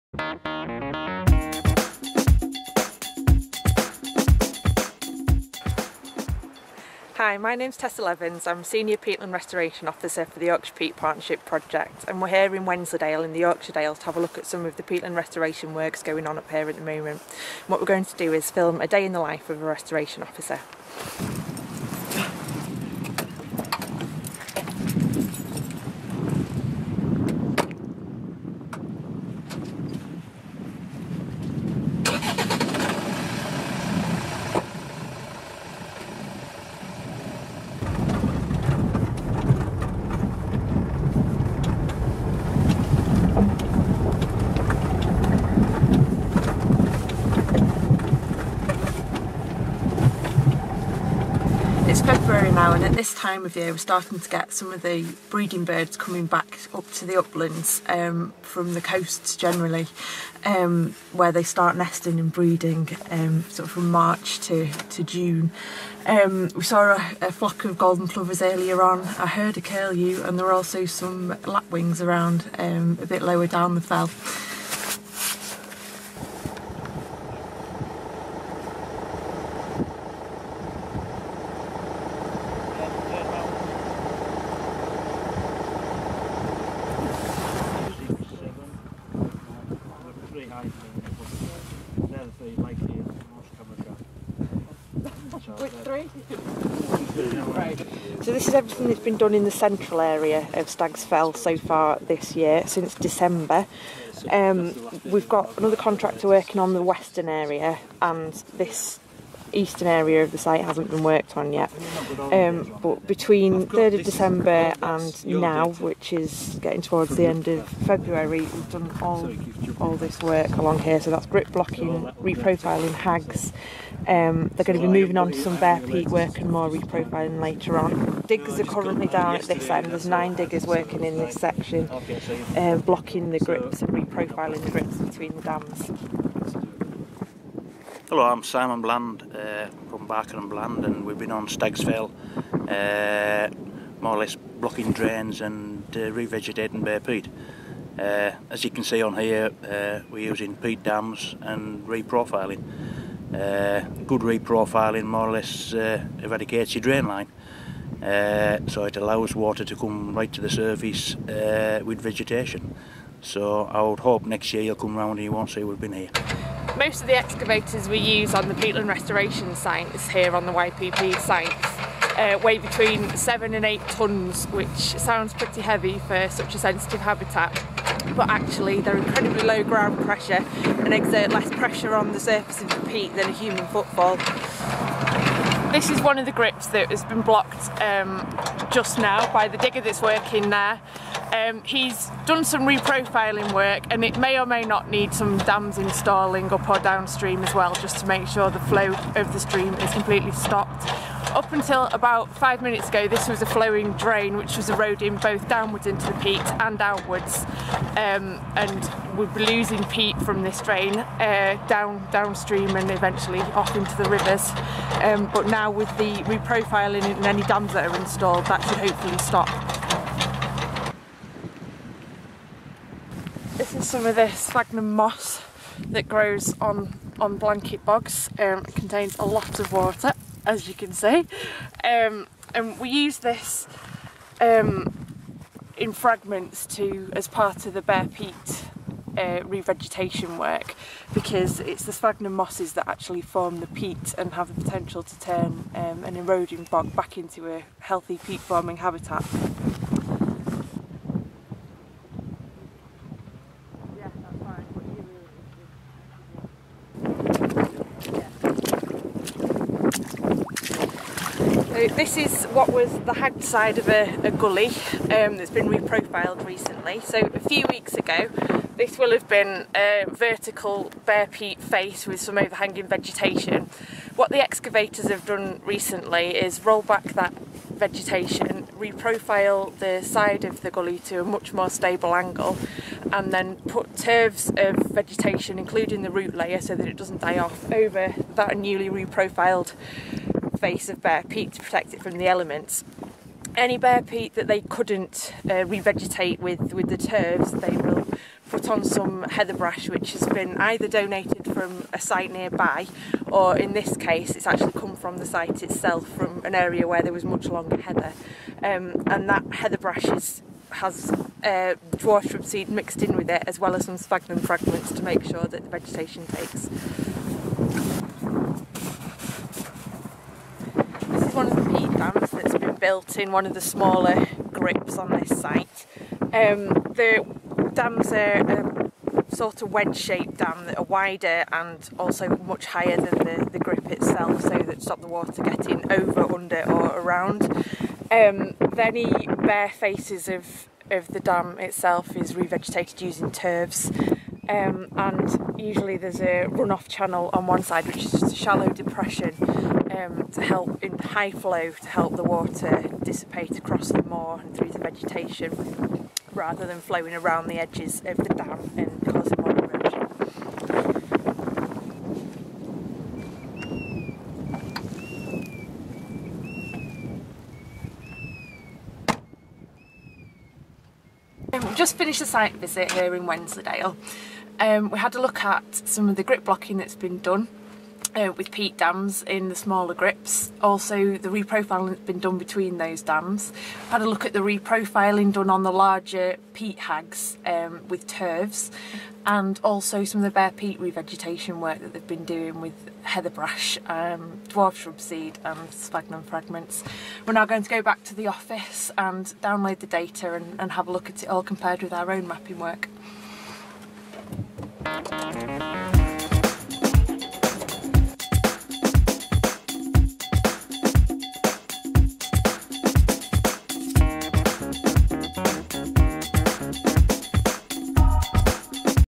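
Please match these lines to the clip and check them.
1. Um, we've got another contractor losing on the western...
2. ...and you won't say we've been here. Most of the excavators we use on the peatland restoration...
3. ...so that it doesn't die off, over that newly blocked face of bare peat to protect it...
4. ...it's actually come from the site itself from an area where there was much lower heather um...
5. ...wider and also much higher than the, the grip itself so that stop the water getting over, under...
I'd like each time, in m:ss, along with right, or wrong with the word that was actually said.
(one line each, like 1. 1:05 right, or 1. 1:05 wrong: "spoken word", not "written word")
1. 1:44 wrong: "working", not "losing"
2. 2:45 right
3. 4:46 wrong: "reprofiled", not "blocked"
4. 5:04 wrong: "longer", not "lower"
5. 5:30 right.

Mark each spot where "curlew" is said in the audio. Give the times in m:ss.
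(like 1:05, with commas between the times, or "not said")
1:09.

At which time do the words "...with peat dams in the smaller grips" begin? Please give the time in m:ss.
6:18.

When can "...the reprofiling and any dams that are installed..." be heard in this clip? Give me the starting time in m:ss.
3:35.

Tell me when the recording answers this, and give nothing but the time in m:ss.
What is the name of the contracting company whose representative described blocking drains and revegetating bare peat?
2:20.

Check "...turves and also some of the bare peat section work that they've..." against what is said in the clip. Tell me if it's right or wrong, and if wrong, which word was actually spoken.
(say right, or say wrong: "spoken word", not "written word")
wrong: "revegetation", not "section".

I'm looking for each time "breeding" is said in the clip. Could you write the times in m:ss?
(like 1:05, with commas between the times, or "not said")
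0:55, 1:02.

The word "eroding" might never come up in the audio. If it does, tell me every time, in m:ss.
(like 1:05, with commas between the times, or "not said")
3:24, 4:06.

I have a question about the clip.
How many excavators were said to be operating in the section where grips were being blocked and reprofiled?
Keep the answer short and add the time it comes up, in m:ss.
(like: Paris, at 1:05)
9, at 2:10.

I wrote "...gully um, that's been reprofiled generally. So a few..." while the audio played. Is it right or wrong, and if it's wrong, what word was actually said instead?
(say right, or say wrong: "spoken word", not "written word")
wrong: "recently", not "generally".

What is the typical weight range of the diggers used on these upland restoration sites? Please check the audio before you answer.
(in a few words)
7 to 8 tonnes.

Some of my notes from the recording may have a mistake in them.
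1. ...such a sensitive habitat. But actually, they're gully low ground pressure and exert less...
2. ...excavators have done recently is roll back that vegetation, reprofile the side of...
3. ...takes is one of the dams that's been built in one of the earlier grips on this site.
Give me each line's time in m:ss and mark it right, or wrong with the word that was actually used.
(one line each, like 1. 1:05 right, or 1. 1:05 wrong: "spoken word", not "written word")
1. 2:56 wrong: "incredibly", not "gully"
2. 4:34 right
3. 5:16 wrong: "smaller", not "earlier".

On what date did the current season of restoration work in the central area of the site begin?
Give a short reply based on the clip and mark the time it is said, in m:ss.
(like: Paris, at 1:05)
3rd of December, at 1:53.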